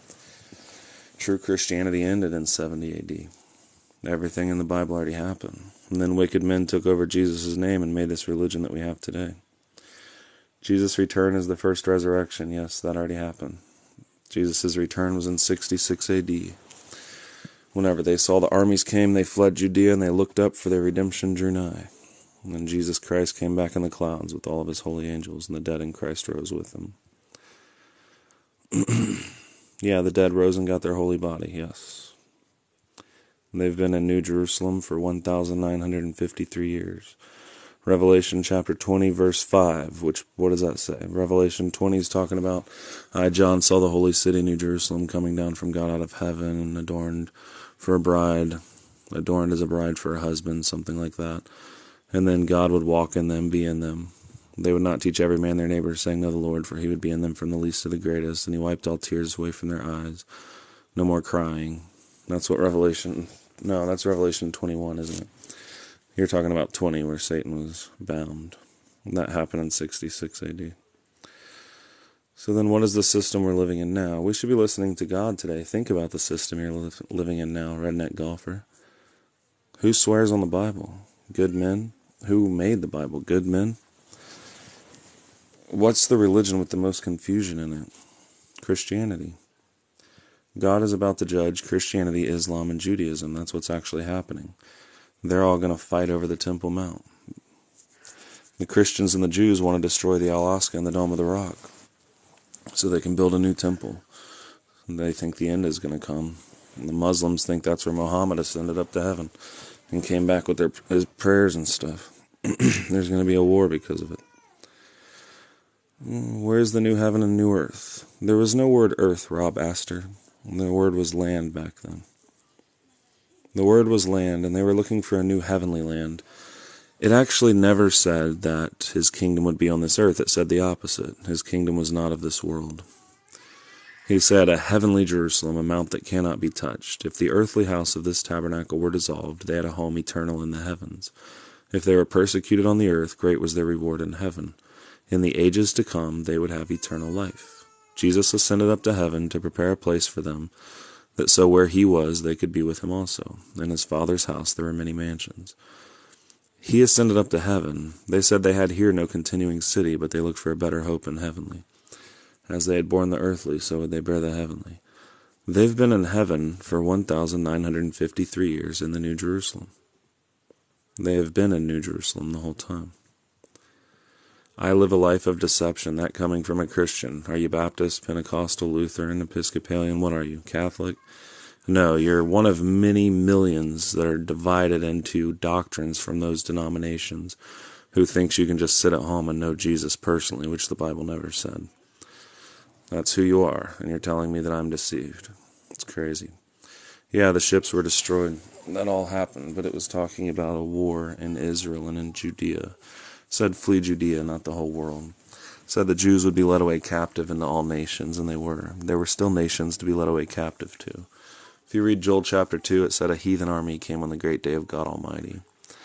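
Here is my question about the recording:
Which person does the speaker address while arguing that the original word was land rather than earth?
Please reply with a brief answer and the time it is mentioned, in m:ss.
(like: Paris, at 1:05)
Rob Astor, at 1:59.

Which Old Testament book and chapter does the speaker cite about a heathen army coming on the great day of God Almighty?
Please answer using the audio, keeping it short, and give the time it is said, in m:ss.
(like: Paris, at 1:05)
Joel chapter 2, at 3:32.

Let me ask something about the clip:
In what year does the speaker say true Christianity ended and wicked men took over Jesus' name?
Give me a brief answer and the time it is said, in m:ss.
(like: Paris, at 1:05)
70 AD, at 0:02.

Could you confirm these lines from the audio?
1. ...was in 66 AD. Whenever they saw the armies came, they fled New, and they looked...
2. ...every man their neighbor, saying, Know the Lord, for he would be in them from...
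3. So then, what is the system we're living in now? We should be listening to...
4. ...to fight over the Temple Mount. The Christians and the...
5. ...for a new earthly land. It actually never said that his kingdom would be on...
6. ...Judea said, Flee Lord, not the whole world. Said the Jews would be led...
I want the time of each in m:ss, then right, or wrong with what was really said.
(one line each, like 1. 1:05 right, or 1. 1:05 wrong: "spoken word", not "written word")
1. 0:15 wrong: "Judea", not "New"
2. 0:55 right
3. 1:12 right
4. 1:35 right
5. 2:05 wrong: "heavenly", not "earthly"
6. 3:22 wrong: "Judea", not "Lord".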